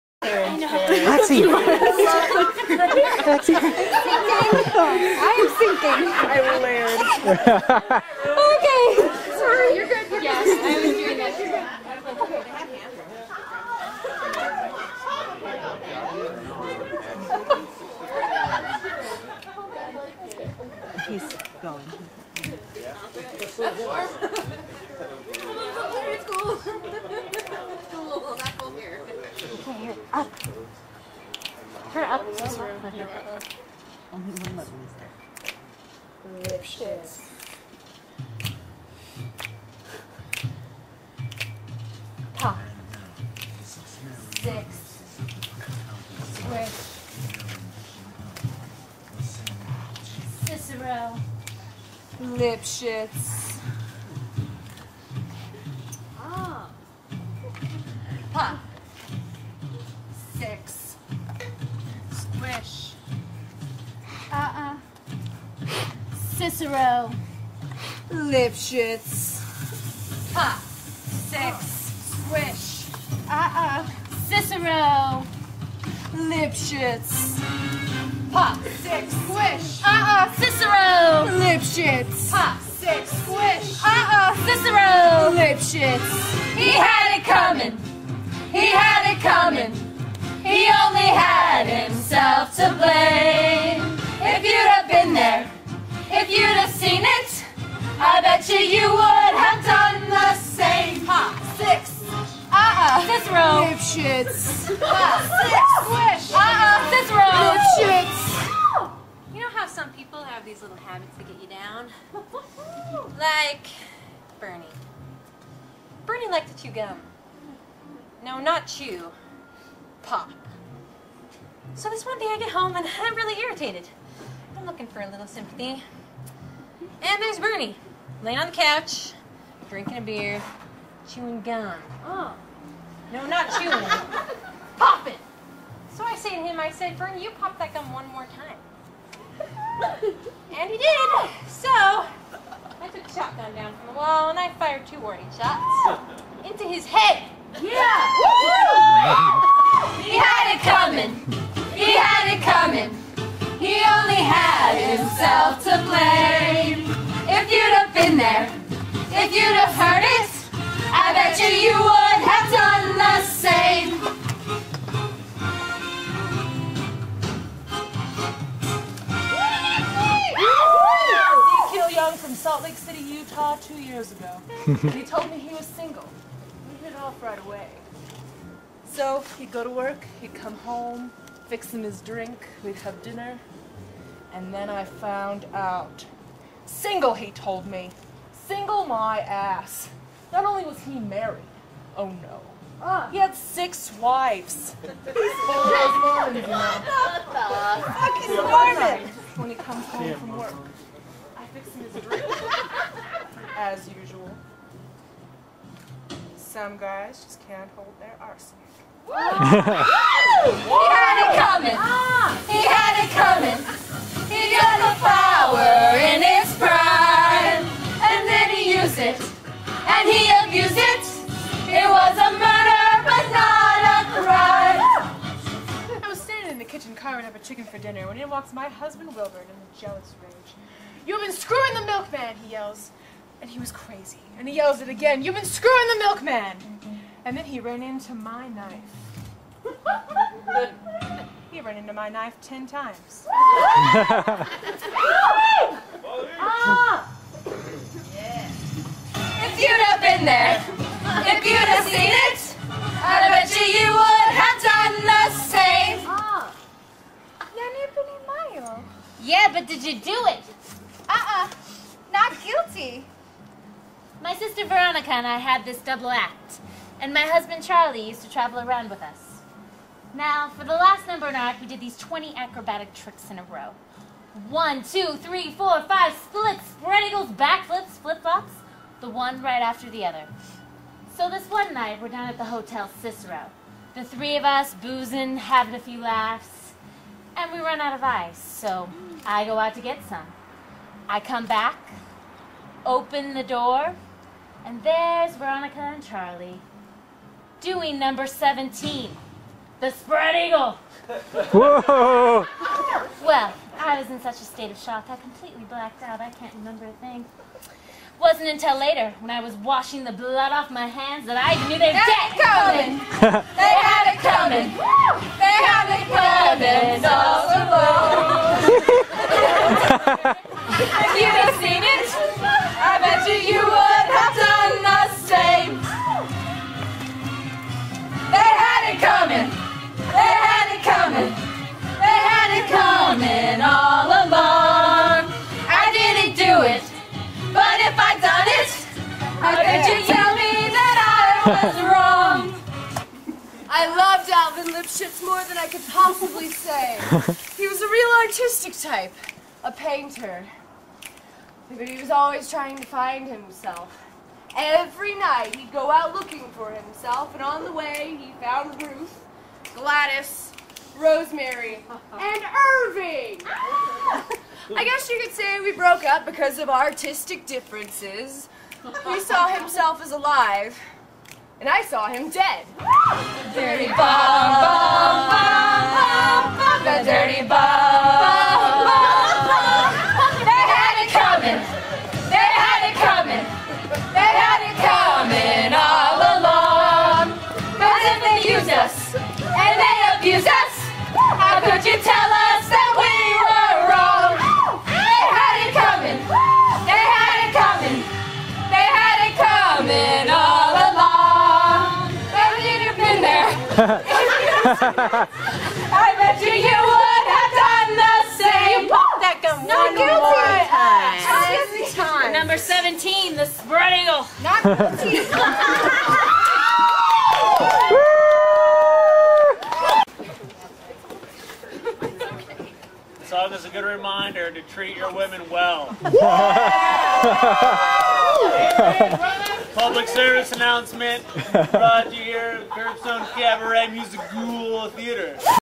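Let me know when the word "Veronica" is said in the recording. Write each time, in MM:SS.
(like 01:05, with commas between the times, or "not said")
04:24, 04:55.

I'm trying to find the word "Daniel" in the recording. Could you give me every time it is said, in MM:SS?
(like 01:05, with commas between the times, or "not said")
not said.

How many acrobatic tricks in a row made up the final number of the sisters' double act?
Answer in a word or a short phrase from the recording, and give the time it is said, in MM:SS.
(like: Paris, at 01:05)
20, at 04:31.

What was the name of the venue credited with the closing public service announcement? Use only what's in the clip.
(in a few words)
Curbstone Cabaret Music Theater.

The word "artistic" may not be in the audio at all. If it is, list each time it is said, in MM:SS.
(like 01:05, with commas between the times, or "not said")
05:48, 06:06.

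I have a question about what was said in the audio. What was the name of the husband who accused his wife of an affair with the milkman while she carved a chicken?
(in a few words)
Wilbur.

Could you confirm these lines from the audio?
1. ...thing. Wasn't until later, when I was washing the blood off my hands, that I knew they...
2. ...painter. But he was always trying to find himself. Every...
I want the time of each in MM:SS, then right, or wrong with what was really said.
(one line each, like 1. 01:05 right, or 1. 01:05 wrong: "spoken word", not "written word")
1. 05:06 right
2. 05:49 right.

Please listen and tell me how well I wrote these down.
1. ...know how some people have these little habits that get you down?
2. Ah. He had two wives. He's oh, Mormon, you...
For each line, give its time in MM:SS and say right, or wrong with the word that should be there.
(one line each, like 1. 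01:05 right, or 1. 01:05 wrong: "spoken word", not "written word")
1. 01:49 right
2. 03:12 wrong: "six", not "two".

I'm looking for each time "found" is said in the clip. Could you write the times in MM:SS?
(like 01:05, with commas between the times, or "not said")
03:04, 05:58.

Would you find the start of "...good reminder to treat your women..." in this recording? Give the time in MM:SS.
07:03.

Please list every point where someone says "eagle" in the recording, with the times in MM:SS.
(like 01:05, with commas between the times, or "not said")
04:37, 05:00, 06:54.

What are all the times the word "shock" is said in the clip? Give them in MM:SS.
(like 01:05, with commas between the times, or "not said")
05:04.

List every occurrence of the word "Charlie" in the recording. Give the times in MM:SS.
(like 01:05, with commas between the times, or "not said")
04:27, 04:56.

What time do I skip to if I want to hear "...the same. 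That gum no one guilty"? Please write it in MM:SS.
06:47.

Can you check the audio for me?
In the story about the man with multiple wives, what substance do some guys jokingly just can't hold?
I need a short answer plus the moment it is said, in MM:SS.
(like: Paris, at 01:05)
Arsenic, at 03:28.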